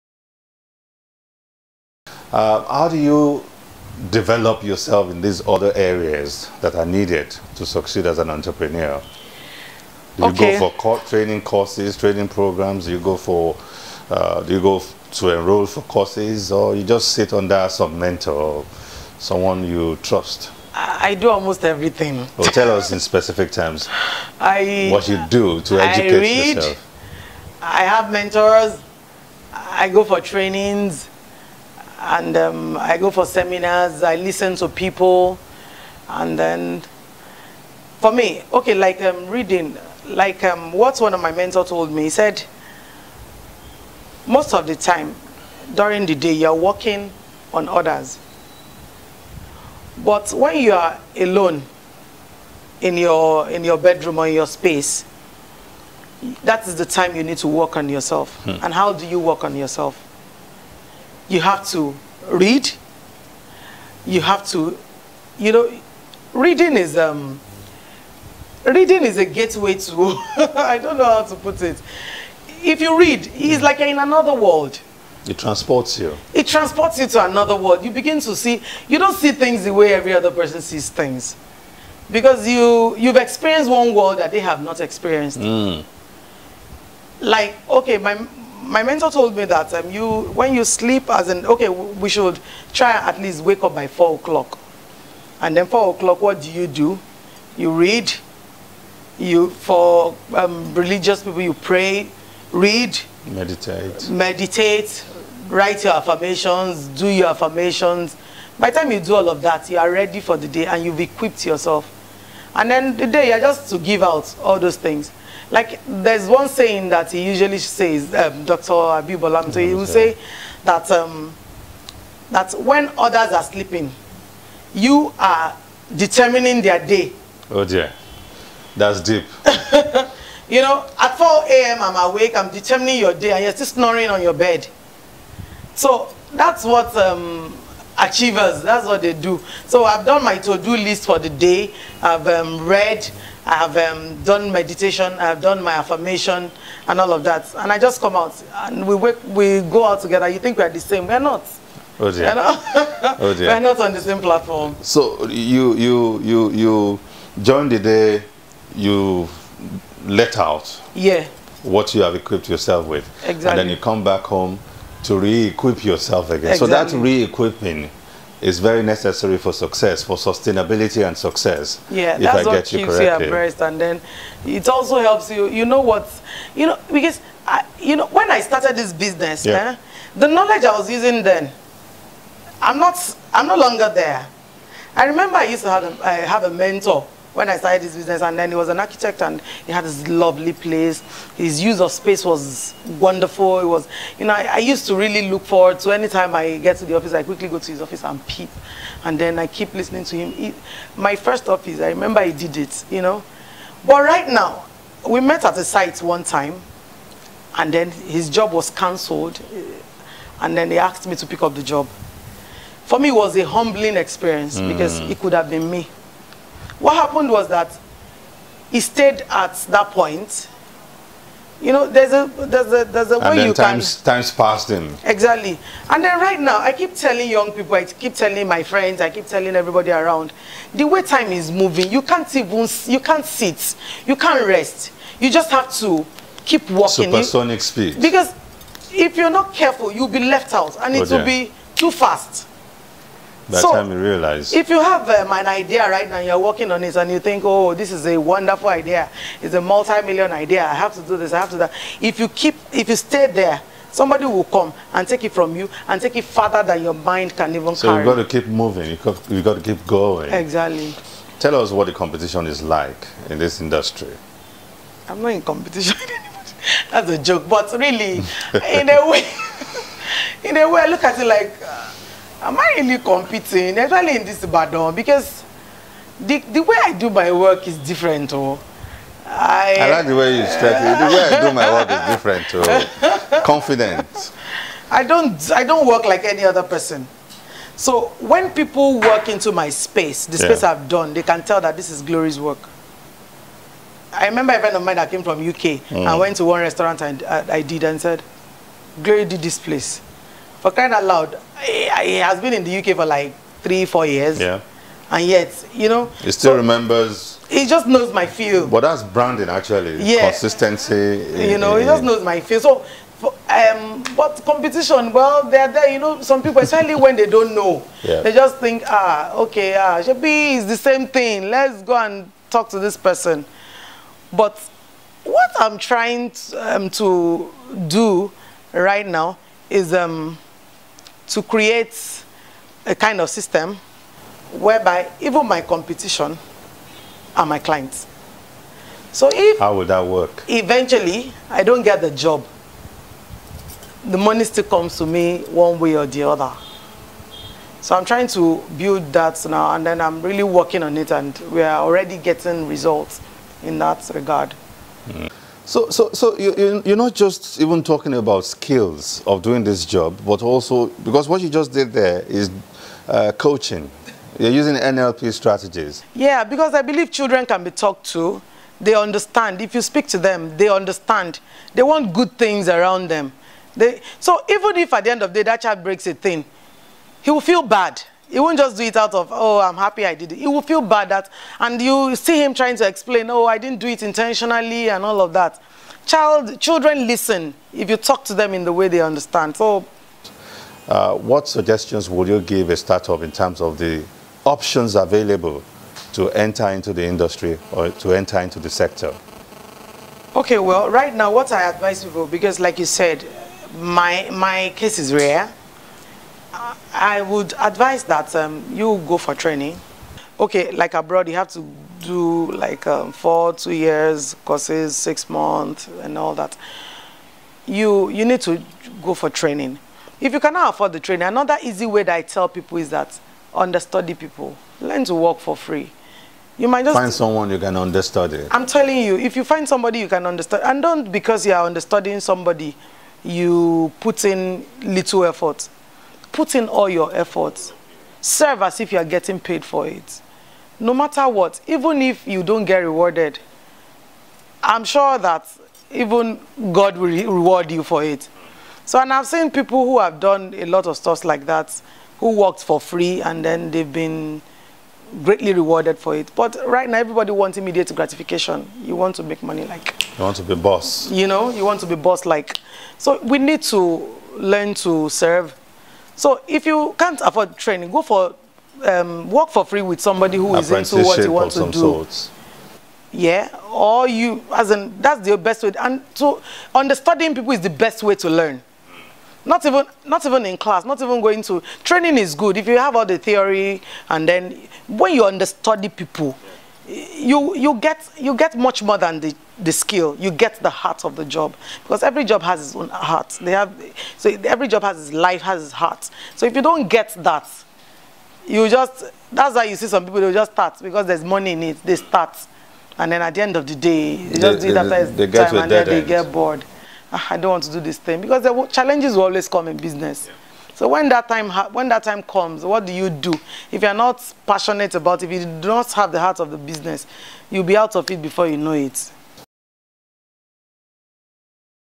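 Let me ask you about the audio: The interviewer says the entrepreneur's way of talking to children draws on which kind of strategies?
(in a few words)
NLP.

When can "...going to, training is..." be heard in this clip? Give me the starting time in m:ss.
8:01.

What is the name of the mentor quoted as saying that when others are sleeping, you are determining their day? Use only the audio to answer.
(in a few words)
Dr. Abibolam.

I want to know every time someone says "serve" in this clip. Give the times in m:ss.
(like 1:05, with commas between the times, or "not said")
7:18, 7:45.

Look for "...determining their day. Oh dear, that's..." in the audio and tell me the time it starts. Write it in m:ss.
2:05.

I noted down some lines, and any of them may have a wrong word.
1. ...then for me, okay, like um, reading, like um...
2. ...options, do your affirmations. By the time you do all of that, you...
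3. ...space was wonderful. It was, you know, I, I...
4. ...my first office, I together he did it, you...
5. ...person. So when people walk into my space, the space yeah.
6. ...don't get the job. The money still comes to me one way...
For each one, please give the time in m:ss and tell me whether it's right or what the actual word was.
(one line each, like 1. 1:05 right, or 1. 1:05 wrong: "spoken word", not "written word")
1. 0:36 right
2. 1:45 wrong: "affirmations", not "options"
3. 3:11 right
4. 3:20 wrong: "remember", not "together"
5. 4:46 right
6. 5:41 right.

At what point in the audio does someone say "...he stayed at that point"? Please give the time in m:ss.
3:38.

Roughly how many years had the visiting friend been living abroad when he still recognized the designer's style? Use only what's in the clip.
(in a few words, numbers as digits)
3 or 4 years.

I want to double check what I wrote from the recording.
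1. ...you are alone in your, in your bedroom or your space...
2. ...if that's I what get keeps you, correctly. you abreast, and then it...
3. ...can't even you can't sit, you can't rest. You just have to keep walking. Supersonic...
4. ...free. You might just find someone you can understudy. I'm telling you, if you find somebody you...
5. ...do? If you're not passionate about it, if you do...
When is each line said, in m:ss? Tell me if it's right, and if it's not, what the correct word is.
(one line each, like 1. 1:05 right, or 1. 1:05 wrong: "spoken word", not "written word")
1. 0:50 right
2. 2:52 right
3. 3:52 right
4. 7:05 right
5. 8:33 right.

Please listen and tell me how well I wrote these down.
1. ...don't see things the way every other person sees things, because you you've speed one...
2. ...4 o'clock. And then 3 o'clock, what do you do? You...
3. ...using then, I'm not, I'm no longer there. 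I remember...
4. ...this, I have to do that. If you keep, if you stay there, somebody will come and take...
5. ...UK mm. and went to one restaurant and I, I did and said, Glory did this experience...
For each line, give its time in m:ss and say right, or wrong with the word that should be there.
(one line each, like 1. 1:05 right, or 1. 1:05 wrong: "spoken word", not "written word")
1. 1:18 wrong: "experienced", not "speed"
2. 1:33 wrong: "4", not "3"
3. 3:00 right
4. 4:11 right
5. 4:55 wrong: "place", not "experience".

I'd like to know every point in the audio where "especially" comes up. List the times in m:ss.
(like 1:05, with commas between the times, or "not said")
4:33, 5:16.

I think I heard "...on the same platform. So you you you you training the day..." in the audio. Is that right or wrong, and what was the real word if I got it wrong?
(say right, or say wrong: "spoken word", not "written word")
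wrong: "during", not "training".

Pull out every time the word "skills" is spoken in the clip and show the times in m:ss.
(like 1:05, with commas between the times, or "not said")
5:58, 8:09.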